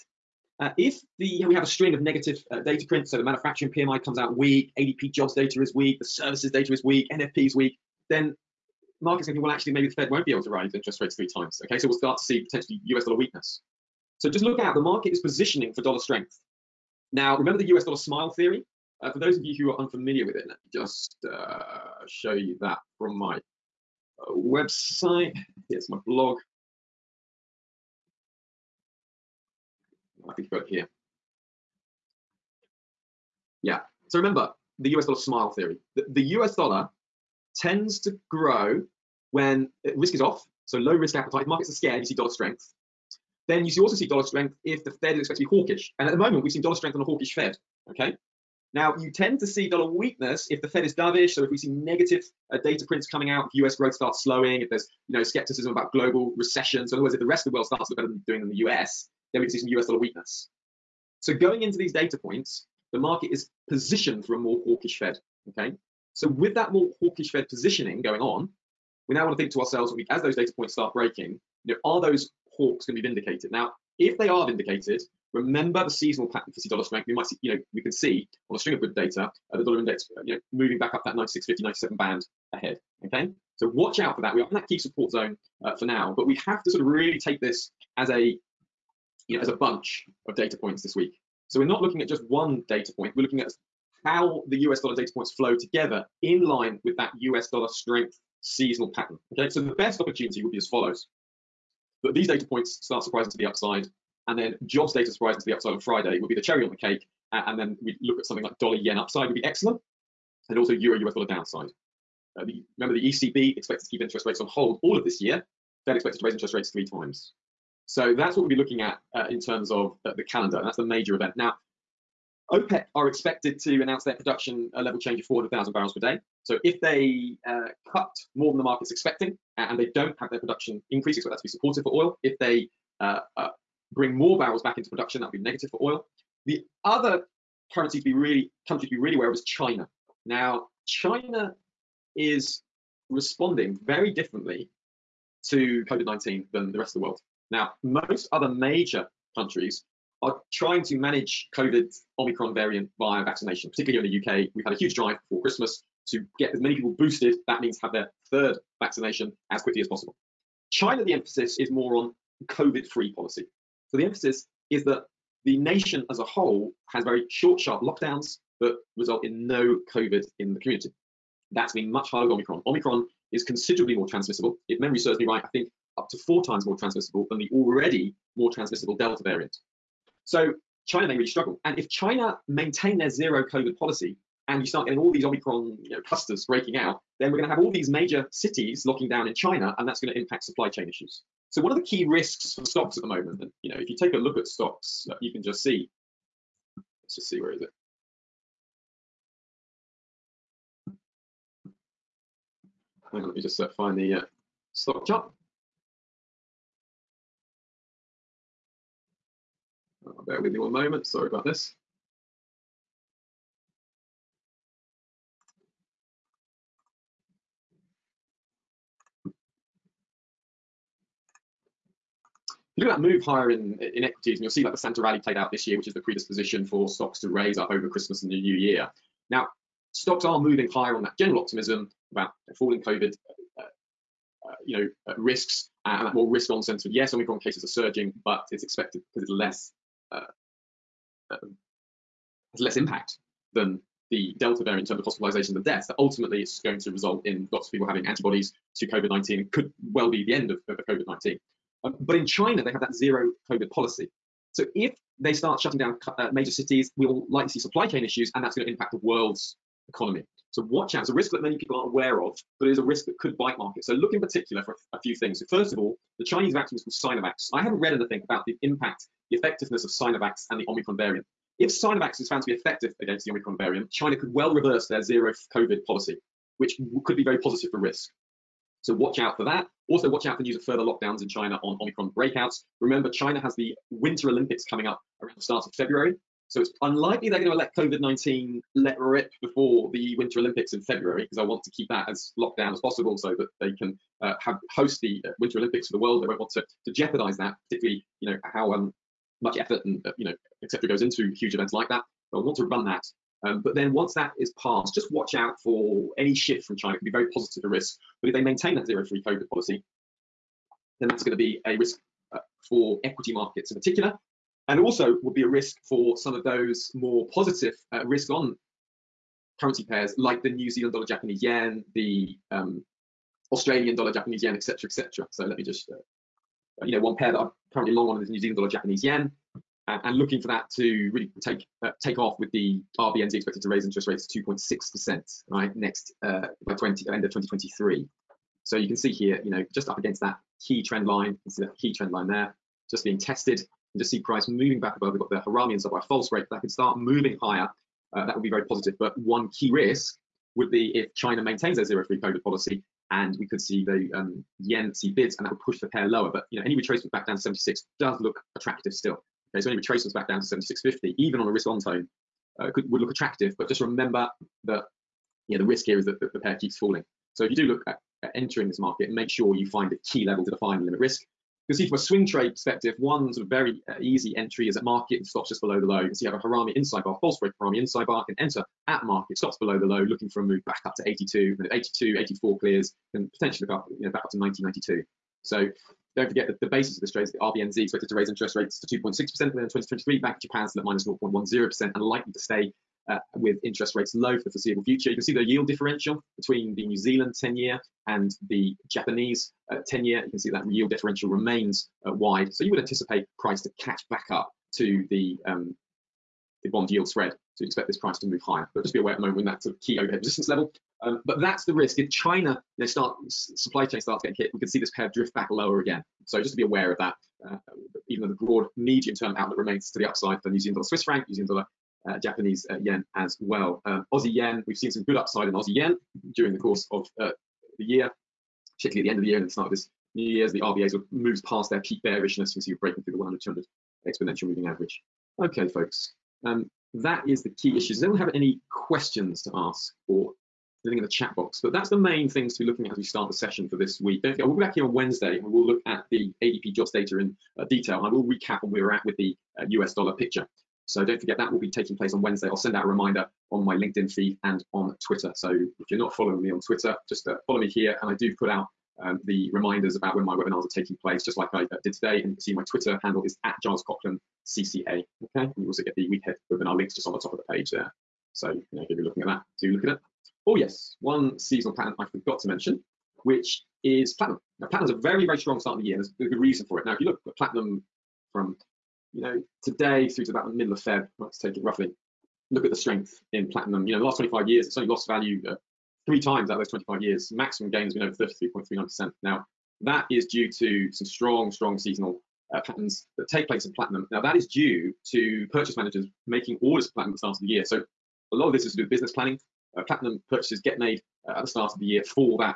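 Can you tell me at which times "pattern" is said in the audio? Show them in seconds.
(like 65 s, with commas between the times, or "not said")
76 s, 98 s, 471 s, 492 s.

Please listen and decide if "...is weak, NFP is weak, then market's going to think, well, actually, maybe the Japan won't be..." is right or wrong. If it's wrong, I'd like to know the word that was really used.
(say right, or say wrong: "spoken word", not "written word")
wrong: "Fed", not "Japan".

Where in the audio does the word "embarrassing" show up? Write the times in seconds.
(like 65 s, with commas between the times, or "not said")
not said.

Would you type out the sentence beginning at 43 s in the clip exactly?
Then you see, also see dollar strength if the Fed is expected to be hawkish.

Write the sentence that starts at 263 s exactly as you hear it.
So look in particular for a few things.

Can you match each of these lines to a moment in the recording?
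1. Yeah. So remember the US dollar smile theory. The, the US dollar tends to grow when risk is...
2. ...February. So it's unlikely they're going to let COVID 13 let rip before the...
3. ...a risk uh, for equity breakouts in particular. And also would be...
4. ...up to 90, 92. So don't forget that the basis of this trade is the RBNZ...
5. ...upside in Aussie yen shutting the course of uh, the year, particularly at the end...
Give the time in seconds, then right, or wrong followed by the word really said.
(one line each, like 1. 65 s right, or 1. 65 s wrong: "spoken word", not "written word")
1. 33 s right
2. 285 s wrong: "19", not "13"
3. 311 s wrong: "markets", not "breakouts"
4. 384 s right
5. 425 s wrong: "during", not "shutting".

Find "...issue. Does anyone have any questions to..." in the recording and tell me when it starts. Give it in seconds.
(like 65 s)
437 s.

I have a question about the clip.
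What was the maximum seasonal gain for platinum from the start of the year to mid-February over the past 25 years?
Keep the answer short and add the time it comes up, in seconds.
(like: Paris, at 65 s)
33.39%, at 488 s.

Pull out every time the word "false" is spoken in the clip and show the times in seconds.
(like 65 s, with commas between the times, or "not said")
346 s, 377 s.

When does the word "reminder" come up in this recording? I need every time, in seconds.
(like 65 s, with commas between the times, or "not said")
452 s, 459 s.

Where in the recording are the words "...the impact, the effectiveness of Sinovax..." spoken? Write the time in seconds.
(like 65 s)
268 s.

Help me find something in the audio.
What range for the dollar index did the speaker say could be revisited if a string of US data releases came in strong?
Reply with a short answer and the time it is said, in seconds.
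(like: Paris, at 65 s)
96.50, 97, at 81 s.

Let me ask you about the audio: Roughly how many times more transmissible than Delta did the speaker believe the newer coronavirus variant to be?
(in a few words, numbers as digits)
4.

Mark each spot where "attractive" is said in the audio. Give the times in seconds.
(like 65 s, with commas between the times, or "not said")
358 s, 363 s.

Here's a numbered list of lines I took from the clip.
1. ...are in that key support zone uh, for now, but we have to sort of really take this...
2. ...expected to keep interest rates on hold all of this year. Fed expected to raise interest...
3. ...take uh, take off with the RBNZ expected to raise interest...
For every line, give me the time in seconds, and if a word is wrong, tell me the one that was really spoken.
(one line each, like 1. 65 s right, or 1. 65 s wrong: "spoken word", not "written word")
1. 84 s right
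2. 113 s right
3. 331 s right.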